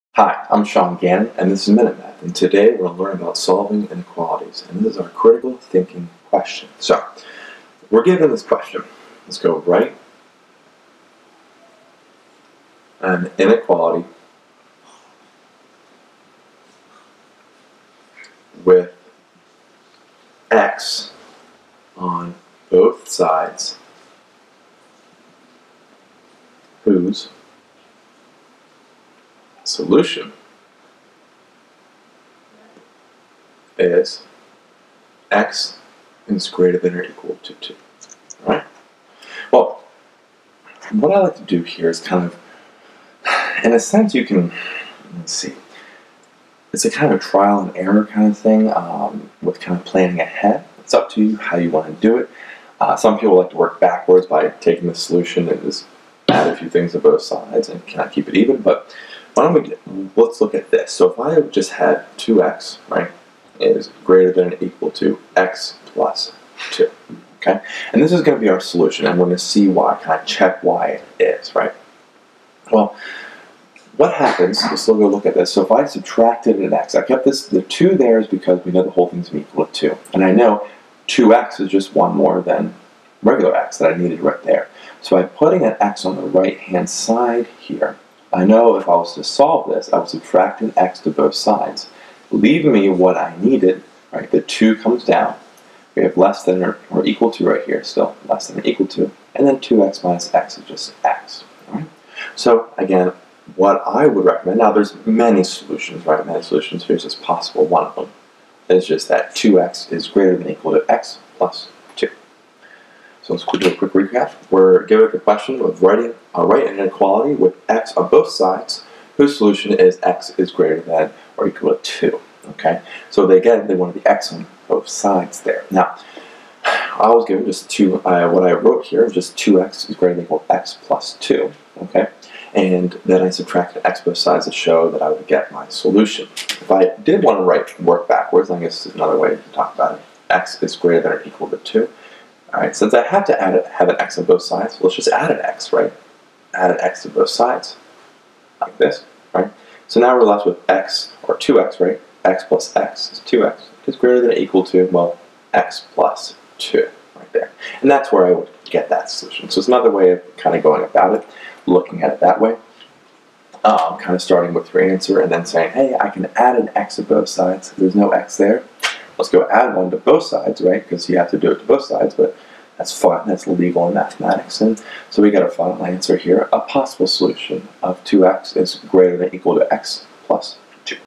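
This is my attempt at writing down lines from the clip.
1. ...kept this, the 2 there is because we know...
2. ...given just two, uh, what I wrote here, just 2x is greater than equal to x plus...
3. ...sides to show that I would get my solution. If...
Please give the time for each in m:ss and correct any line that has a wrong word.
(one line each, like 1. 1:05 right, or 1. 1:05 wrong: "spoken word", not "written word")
1. 1:17 right
2. 2:07 right
3. 2:14 right.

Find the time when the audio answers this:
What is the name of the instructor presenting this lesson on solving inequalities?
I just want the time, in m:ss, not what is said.
0:00.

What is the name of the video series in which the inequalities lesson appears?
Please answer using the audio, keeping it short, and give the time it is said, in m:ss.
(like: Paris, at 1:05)
Minute Math, at 0:01.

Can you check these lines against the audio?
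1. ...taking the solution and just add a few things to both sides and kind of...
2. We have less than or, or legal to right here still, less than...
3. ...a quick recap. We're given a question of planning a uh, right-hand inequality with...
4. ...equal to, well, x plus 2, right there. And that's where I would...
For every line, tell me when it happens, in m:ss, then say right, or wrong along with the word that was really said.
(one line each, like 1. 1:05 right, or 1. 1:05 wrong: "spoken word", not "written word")
1. 0:54 right
2. 1:35 wrong: "equal", not "legal"
3. 1:53 wrong: "writing", not "planning"
4. 2:34 right.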